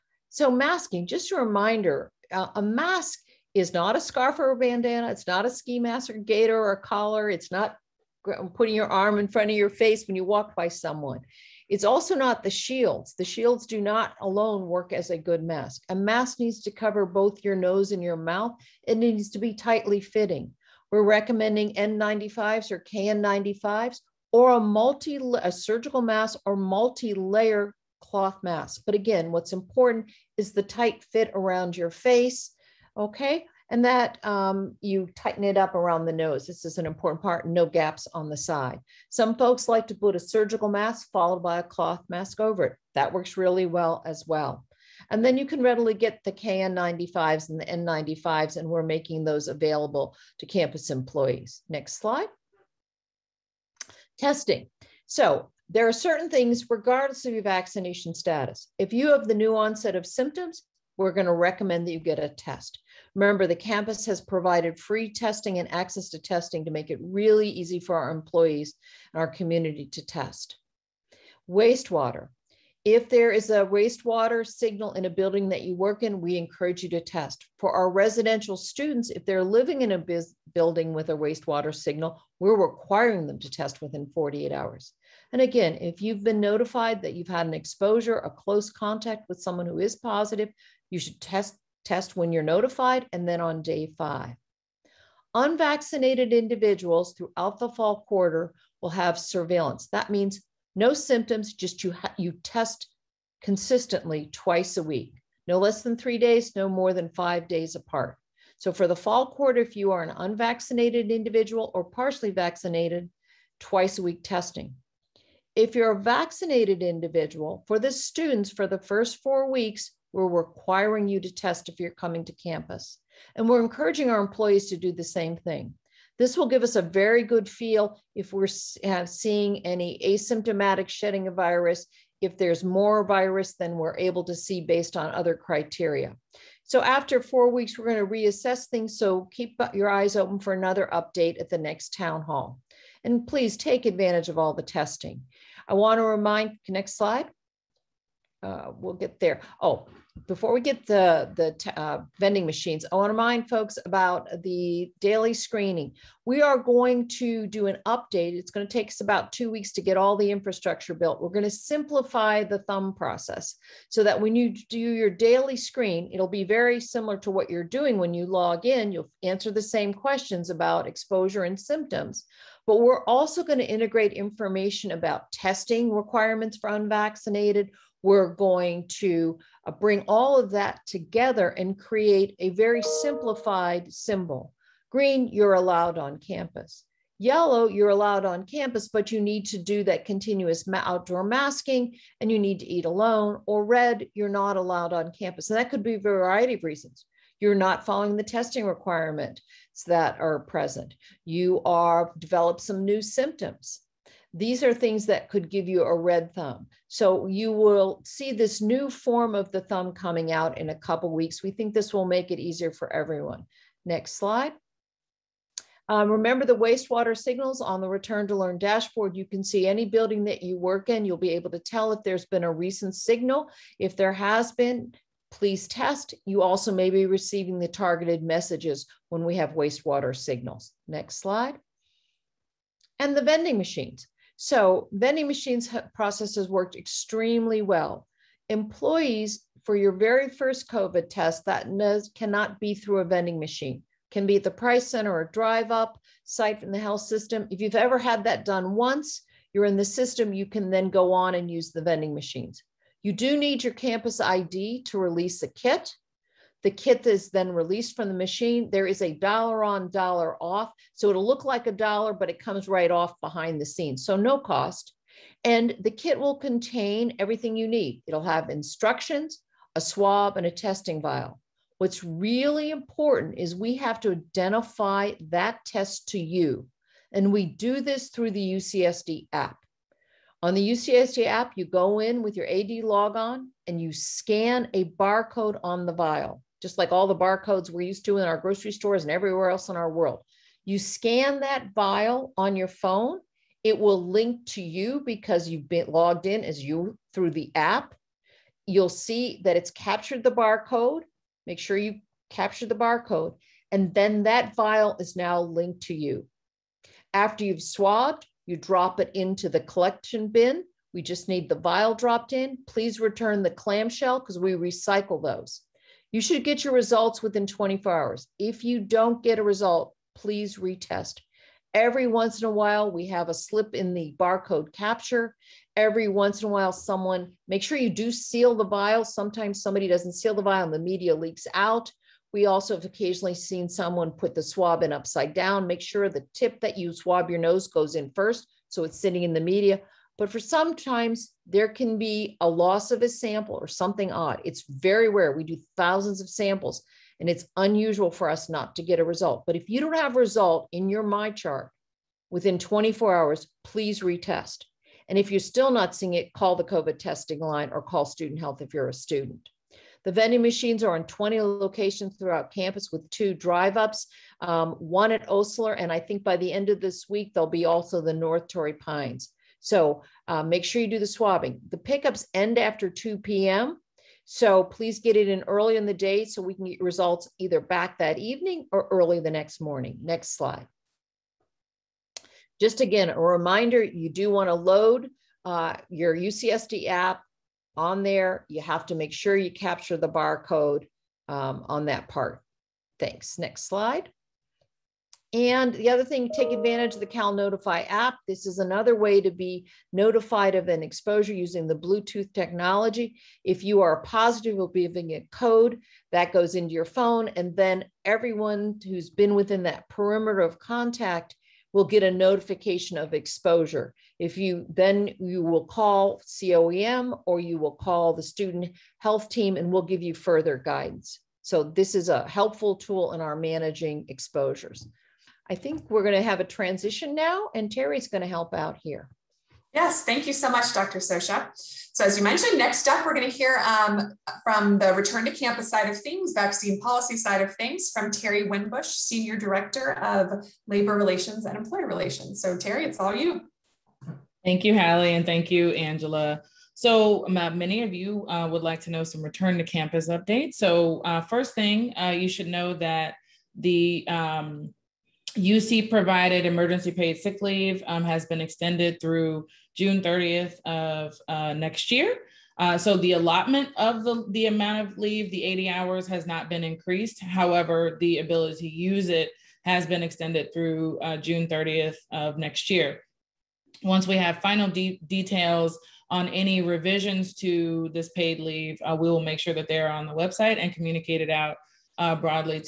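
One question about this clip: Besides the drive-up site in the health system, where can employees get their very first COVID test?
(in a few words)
Price Center.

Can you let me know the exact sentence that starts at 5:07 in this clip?
After you've swabbed, you drop it into the collection bin.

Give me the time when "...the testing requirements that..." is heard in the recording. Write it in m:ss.
3:18.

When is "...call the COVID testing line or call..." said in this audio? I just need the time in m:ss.
5:56.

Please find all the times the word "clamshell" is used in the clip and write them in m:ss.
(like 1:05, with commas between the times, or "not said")
5:13.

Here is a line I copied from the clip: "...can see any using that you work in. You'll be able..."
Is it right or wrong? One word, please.
wrong.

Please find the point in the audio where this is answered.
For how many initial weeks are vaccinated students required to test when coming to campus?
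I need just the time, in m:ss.
1:58.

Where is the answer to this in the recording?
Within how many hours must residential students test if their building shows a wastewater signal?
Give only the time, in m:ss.
1:24.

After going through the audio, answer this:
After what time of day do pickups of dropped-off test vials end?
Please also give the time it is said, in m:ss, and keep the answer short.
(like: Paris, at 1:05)
2 p.m., at 6:12.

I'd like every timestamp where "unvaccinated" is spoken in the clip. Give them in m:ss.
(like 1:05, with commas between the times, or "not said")
1:35, 1:50, 2:56.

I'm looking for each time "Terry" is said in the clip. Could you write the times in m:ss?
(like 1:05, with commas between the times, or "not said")
7:07, 7:18, 7:22.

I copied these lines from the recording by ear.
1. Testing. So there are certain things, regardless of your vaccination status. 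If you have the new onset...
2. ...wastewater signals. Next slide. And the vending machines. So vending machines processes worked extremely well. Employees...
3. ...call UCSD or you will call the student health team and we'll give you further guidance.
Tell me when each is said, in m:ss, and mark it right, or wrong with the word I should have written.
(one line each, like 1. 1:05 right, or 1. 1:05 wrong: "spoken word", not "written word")
1. 0:54 right
2. 3:49 right
3. 6:55 wrong: "COEM", not "UCSD".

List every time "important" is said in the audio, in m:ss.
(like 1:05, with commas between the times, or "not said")
0:29, 0:36, 4:32.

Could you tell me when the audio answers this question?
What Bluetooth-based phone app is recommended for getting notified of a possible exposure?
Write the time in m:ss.
6:37.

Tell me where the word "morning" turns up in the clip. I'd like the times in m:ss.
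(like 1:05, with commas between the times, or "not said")
6:19.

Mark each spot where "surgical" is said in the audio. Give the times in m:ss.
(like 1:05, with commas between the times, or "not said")
0:25, 0:40.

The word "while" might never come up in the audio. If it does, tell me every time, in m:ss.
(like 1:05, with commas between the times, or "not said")
5:22, 5:26.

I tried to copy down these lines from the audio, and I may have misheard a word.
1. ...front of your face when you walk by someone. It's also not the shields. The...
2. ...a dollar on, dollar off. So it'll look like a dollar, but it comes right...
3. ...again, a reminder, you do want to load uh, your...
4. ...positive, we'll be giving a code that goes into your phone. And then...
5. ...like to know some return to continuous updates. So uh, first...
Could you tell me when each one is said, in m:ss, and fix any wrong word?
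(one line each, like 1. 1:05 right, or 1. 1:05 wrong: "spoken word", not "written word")
1. 0:09 right
2. 4:18 right
3. 6:22 right
4. 6:43 right
5. 7:28 wrong: "campus", not "continuous".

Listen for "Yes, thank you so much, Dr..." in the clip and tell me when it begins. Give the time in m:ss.
7:09.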